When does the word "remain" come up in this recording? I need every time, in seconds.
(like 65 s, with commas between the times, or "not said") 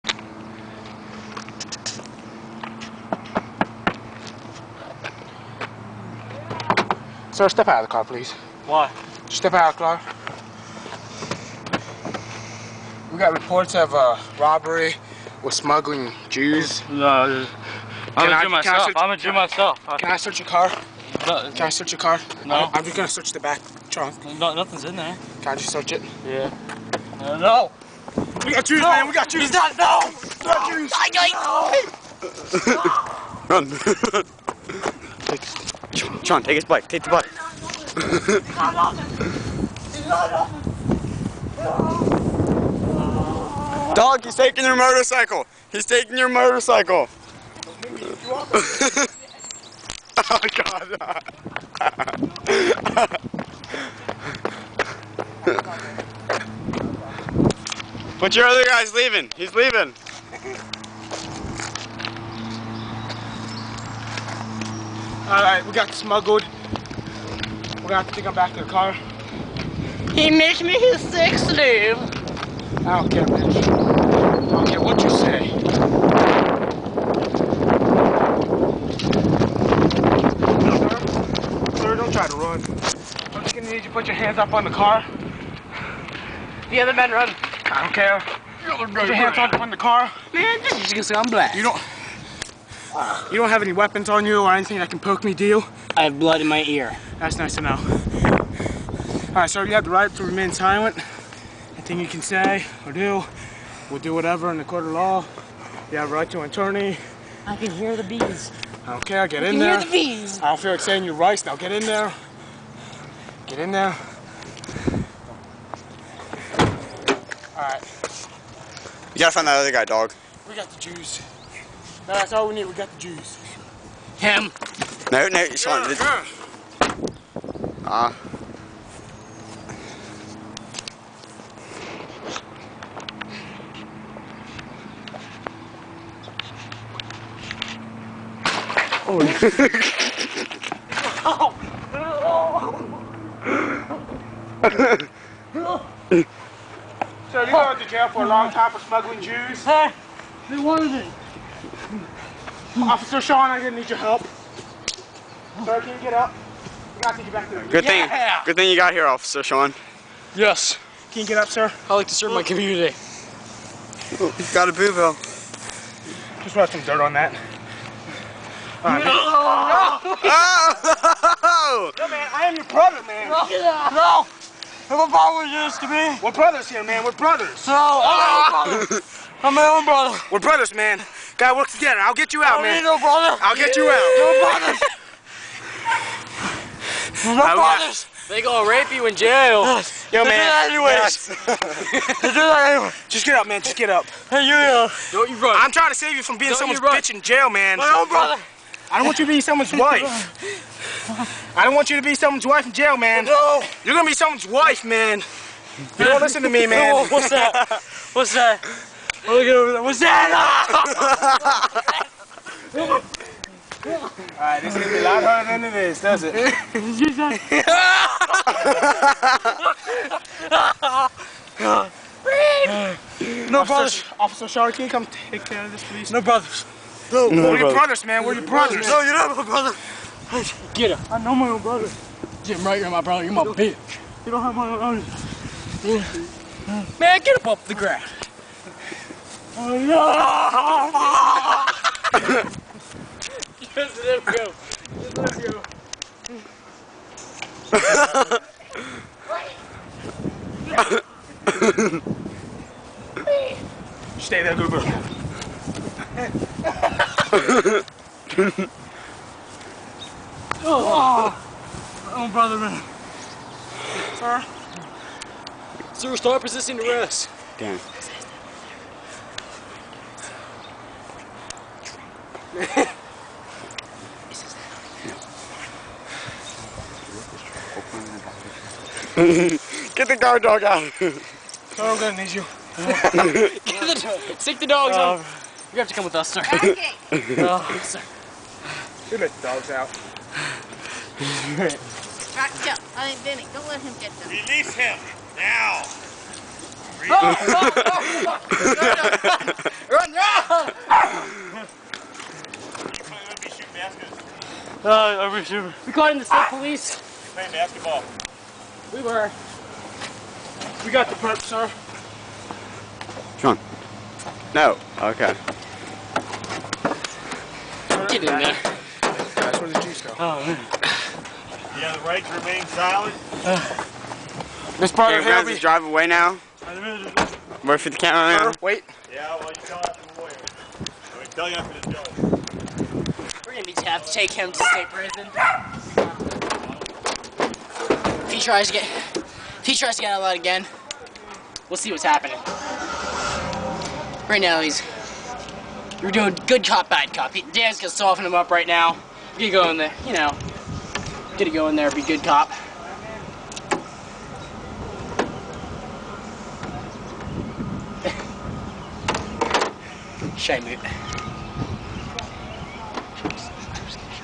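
100 s, 322 s.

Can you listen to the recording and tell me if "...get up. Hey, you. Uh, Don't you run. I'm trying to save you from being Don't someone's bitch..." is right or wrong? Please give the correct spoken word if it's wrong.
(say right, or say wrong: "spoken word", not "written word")
right.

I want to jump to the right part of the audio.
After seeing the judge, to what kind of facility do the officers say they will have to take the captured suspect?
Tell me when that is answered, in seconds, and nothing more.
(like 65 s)
334 s.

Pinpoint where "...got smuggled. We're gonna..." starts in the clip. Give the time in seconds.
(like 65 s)
65 s.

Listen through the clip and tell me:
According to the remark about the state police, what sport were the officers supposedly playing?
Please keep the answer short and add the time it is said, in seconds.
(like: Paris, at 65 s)
Basketball, at 307 s.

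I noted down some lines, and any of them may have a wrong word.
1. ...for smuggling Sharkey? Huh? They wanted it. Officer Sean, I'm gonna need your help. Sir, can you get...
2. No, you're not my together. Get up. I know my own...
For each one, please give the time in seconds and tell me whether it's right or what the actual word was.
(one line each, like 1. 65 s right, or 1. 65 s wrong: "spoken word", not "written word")
1. 148 s wrong: "Jews", not "Sharkey"
2. 228 s wrong: "brother", not "together".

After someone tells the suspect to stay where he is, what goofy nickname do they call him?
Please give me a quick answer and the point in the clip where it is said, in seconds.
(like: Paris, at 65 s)
Goober, at 254 s.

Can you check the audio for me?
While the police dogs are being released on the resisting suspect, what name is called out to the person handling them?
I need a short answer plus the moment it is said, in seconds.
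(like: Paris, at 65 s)
Benny, at 293 s.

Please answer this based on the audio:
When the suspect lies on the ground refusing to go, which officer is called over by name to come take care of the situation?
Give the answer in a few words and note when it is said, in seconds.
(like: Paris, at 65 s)
Officer Sharkey, at 224 s.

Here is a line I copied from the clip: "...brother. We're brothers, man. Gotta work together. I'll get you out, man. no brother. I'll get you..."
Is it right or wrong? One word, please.
right.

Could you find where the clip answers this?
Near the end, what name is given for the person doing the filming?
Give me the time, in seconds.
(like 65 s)
327 s.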